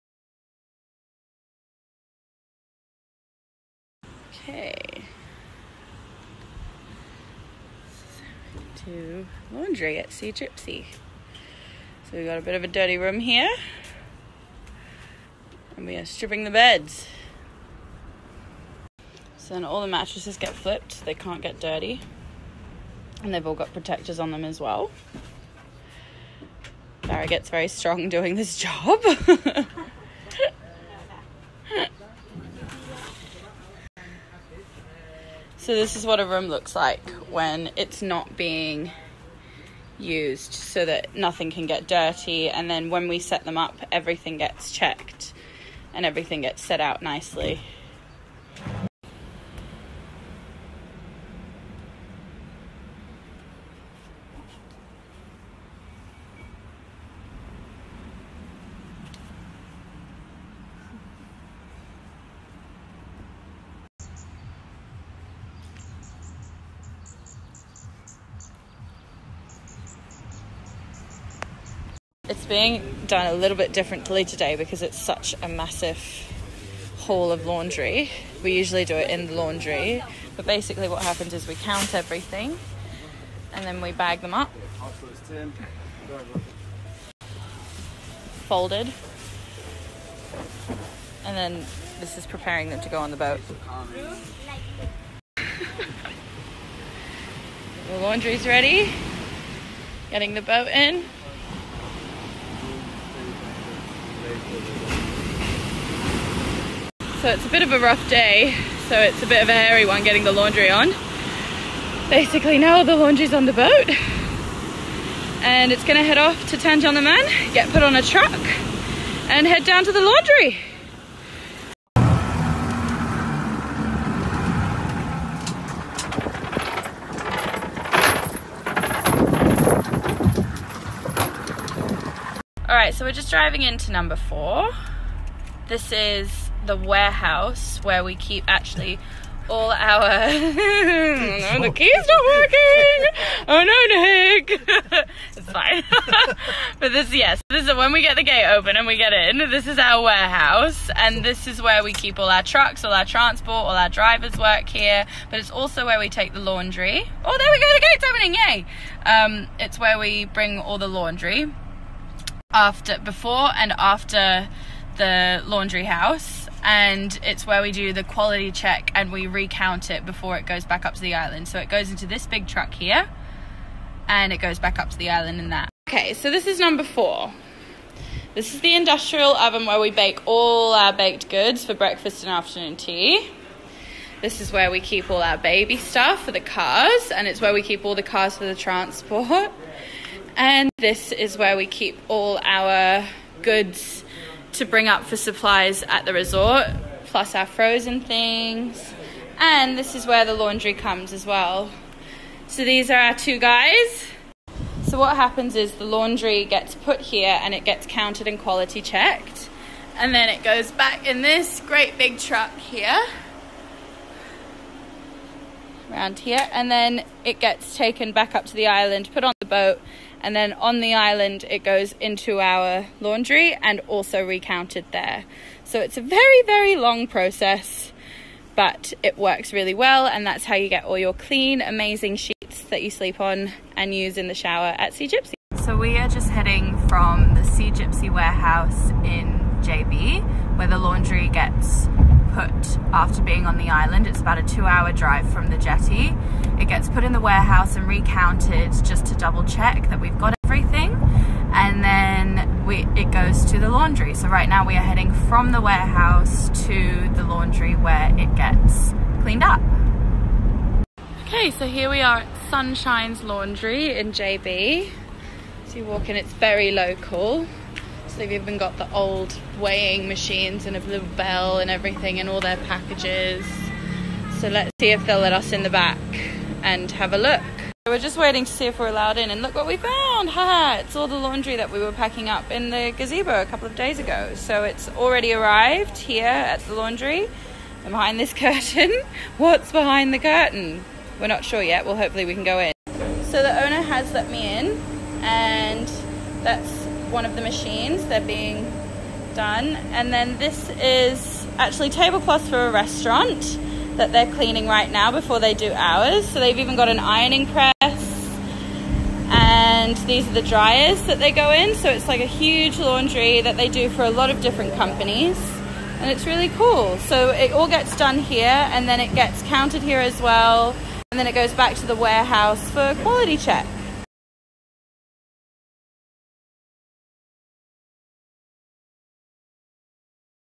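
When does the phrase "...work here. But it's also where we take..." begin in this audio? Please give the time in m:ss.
2:34.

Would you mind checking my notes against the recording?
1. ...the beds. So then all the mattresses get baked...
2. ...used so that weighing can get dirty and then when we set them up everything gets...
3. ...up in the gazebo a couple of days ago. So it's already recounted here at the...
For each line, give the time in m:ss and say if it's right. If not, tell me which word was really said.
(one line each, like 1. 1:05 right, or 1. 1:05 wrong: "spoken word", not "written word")
1. 0:16 wrong: "flipped", not "baked"
2. 0:39 wrong: "nothing", not "weighing"
3. 4:42 wrong: "arrived", not "recounted".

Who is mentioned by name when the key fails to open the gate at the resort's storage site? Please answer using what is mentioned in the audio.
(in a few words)
Nick.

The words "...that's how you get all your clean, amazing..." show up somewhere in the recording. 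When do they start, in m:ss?
3:50.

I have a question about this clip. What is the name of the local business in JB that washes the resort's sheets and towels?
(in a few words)
Sunshine's Laundry.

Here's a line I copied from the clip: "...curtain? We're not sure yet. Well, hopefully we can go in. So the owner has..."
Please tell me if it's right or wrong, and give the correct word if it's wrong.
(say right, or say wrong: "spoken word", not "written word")
right.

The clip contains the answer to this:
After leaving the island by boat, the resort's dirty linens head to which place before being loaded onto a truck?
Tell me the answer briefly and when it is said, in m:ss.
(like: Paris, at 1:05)
Tanjung Leman, at 1:56.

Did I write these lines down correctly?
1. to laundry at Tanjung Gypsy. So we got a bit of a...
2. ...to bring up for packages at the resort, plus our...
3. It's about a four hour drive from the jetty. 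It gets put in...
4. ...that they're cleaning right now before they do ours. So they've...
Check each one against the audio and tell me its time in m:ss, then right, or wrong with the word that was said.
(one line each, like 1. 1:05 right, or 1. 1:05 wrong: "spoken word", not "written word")
1. 0:08 wrong: "Sea", not "Tanjung"
2. 3:14 wrong: "supplies", not "packages"
3. 4:04 wrong: "two", not "four"
4. 5:03 right.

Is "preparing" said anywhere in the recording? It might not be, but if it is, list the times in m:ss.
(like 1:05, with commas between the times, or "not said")
1:32.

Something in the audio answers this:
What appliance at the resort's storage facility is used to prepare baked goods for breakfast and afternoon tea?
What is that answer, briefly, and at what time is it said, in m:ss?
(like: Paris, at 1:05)
industrial oven, at 2:58.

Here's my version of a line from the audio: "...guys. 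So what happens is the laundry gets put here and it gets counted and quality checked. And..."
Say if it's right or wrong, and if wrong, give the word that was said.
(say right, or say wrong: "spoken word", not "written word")
right.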